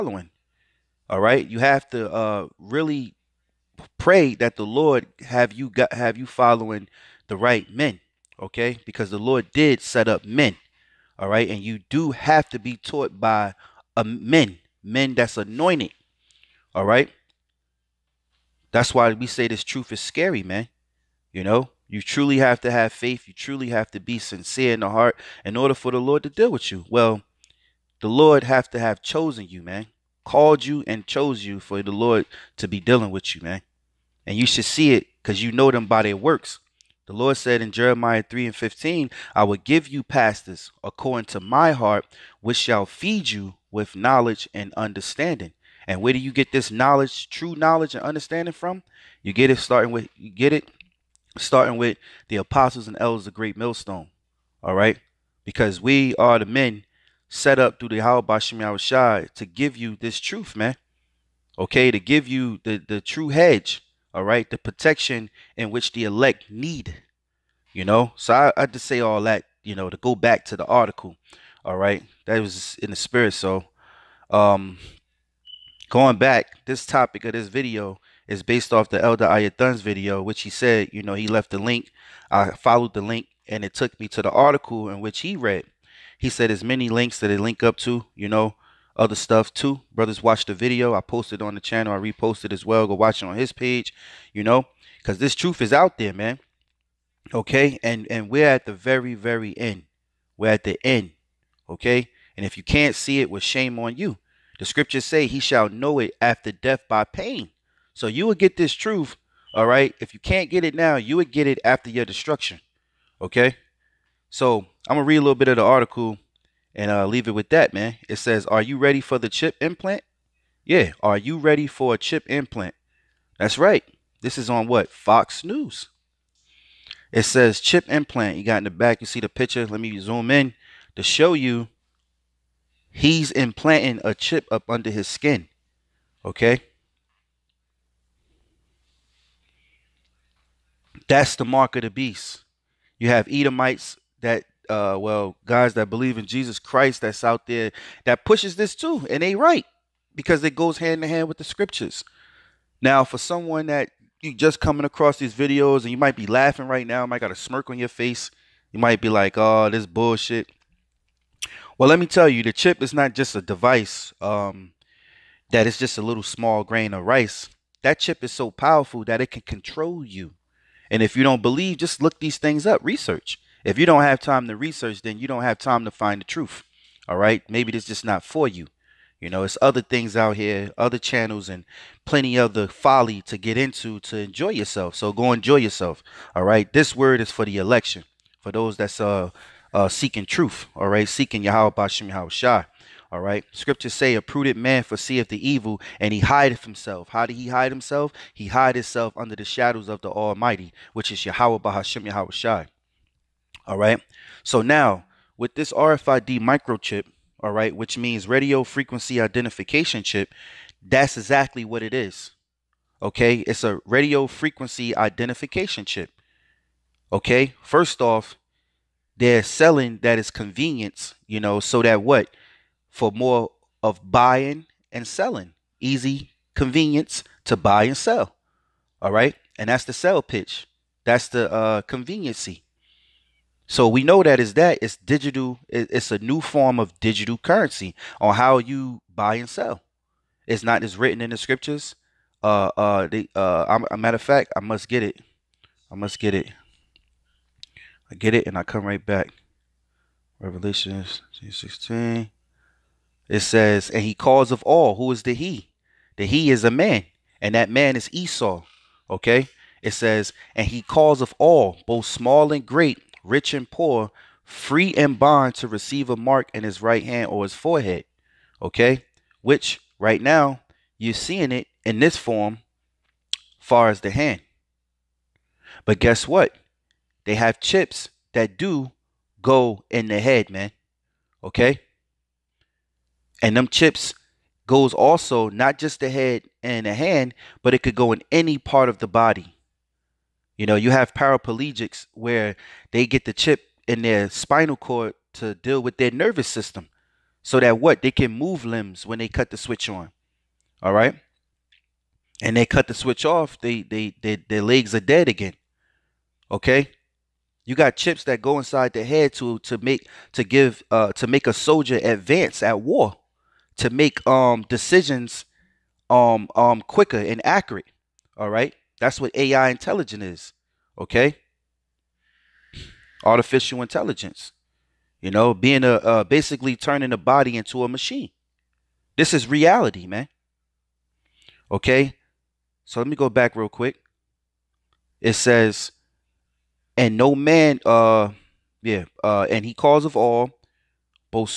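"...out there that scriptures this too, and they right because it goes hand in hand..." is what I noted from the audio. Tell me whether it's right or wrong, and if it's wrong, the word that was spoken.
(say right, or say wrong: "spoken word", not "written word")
wrong: "pushes", not "scriptures".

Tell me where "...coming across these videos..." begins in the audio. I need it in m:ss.
2:34.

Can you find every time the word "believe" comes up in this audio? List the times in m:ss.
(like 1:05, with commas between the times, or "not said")
2:25, 2:51.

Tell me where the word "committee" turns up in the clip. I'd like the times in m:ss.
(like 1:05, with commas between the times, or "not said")
not said.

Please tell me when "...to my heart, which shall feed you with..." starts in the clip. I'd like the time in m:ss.
0:41.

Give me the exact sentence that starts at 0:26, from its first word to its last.
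Well, the Lord have to have chosen you, man.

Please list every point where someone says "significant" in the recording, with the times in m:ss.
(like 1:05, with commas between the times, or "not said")
not said.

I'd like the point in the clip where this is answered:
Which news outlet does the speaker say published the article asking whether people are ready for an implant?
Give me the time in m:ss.
2:04.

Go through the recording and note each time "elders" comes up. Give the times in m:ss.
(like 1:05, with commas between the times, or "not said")
0:52, 1:19.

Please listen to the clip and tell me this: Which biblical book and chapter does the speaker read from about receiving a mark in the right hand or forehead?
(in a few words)
Revelation 16.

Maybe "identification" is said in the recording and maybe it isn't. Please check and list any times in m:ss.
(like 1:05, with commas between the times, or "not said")
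3:29, 3:34.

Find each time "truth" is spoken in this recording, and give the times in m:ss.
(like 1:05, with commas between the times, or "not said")
0:19, 1:00, 1:35, 1:48, 2:56, 3:10.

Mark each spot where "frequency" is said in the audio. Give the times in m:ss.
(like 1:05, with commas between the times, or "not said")
3:28, 3:34.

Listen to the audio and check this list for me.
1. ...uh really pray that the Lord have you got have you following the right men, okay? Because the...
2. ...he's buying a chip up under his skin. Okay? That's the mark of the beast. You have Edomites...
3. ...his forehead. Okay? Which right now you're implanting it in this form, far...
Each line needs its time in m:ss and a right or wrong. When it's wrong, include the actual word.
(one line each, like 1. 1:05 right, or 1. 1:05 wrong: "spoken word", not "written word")
1. 0:02 right
2. 2:12 wrong: "implanting", not "buying"
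3. 4:27 wrong: "seeing", not "implanting".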